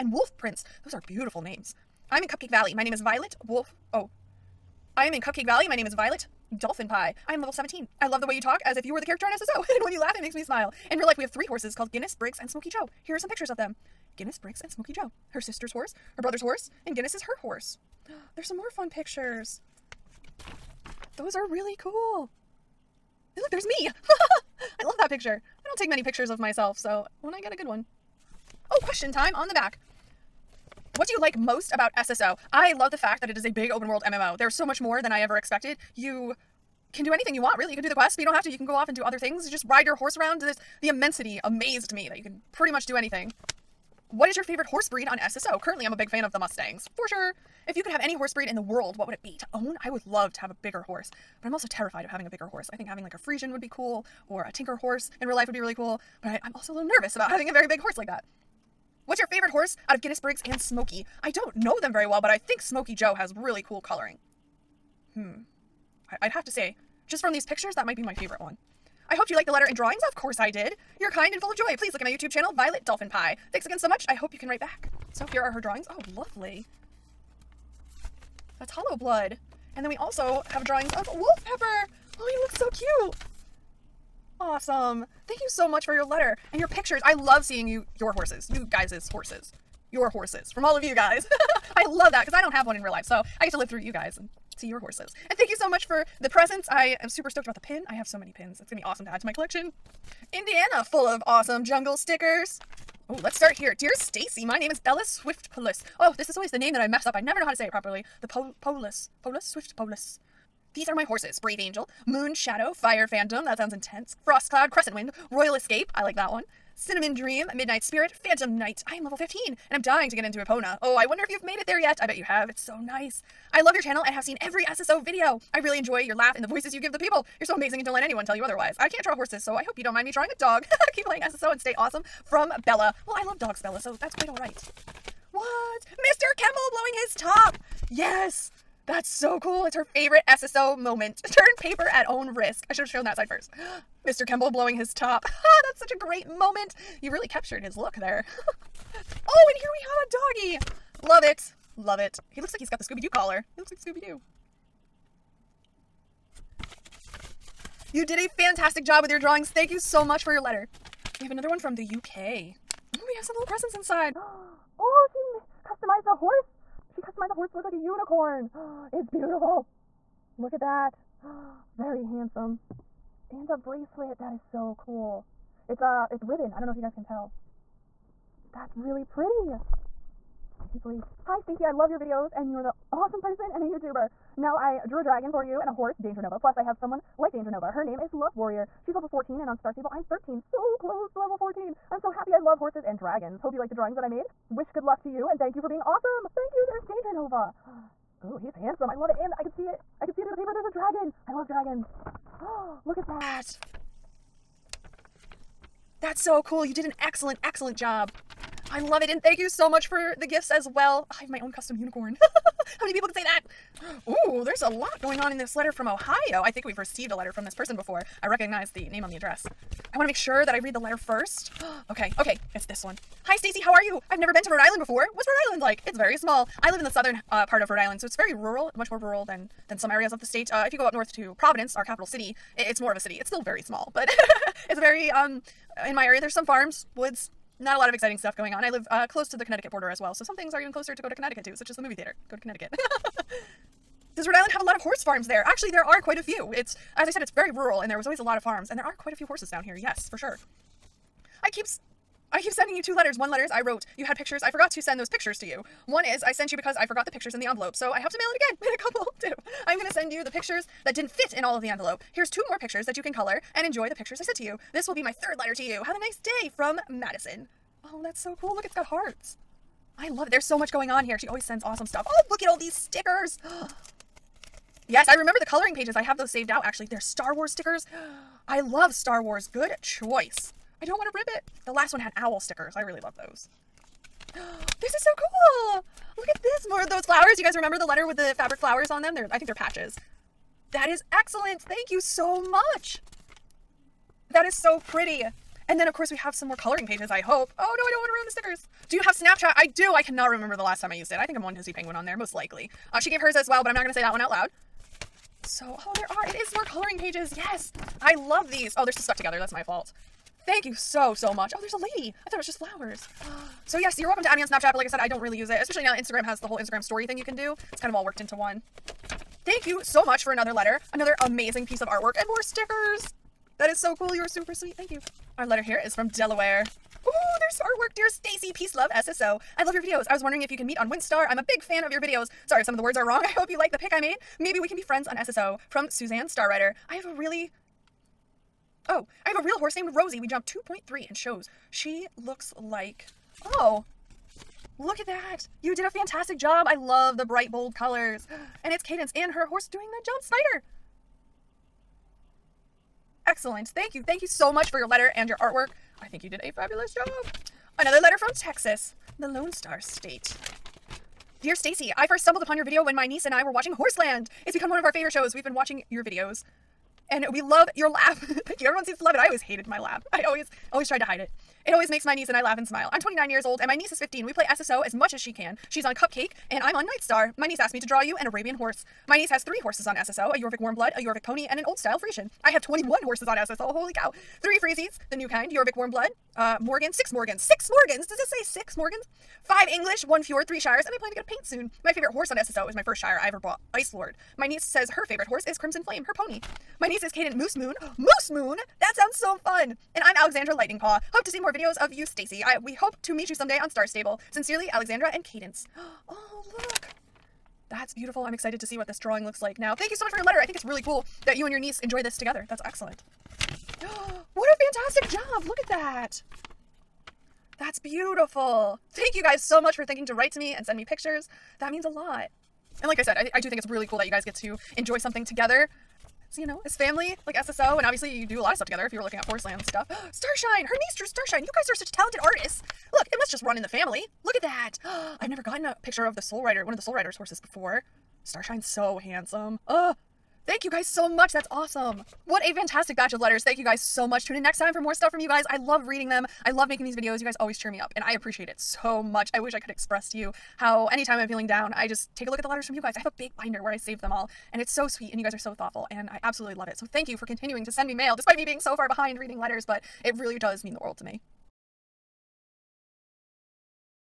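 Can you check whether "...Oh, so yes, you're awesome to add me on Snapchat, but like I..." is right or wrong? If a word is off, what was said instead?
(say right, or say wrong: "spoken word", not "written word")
wrong: "welcome", not "awesome".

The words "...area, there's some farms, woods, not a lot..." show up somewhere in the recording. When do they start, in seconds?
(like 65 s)
236 s.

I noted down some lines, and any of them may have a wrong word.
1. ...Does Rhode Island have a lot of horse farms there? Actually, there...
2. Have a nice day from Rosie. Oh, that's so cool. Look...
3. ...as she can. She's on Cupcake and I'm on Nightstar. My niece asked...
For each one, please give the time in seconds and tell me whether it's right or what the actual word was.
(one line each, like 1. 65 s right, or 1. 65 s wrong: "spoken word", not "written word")
1. 244 s right
2. 265 s wrong: "Madison", not "Rosie"
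3. 375 s right.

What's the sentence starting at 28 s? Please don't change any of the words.
Oh, question time on the back.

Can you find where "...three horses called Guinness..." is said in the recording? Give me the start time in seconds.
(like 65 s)
11 s.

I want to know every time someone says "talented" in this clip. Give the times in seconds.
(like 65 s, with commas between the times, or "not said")
431 s.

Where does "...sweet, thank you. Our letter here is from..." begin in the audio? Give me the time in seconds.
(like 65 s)
324 s.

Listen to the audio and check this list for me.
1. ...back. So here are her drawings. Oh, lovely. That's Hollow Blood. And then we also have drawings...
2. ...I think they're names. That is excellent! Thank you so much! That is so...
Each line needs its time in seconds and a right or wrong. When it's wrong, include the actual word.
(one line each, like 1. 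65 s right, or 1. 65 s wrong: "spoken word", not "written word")
1. 74 s right
2. 289 s wrong: "patches", not "names".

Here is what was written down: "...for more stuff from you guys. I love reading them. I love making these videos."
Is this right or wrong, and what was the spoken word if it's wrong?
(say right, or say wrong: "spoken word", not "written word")
right.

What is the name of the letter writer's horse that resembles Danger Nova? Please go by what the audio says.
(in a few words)
Love Warrior.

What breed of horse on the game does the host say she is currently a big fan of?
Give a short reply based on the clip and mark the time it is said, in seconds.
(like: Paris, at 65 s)
Mustangs, at 46 s.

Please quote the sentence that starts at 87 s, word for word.
I love seeing you your horses.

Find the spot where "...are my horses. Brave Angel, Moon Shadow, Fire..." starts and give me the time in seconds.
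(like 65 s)
110 s.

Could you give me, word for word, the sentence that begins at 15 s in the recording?
Her sister's horse, her brother's horse, and Guinness is her horse.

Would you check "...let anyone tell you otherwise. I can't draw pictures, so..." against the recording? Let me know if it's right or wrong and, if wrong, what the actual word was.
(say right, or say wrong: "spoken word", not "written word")
wrong: "horses", not "pictures".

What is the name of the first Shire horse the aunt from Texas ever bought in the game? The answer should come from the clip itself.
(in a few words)
Ice Lord.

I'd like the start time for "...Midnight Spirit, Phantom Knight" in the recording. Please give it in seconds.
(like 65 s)
117 s.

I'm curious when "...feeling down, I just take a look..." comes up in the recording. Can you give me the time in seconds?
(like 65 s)
451 s.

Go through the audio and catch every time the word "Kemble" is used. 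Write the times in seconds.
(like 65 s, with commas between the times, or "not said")
136 s, 144 s.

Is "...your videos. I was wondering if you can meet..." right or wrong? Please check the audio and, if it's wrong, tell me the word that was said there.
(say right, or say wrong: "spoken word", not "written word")
right.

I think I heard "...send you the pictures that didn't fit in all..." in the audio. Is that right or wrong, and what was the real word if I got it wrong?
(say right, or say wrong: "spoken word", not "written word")
right.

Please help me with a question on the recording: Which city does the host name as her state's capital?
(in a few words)
Providence.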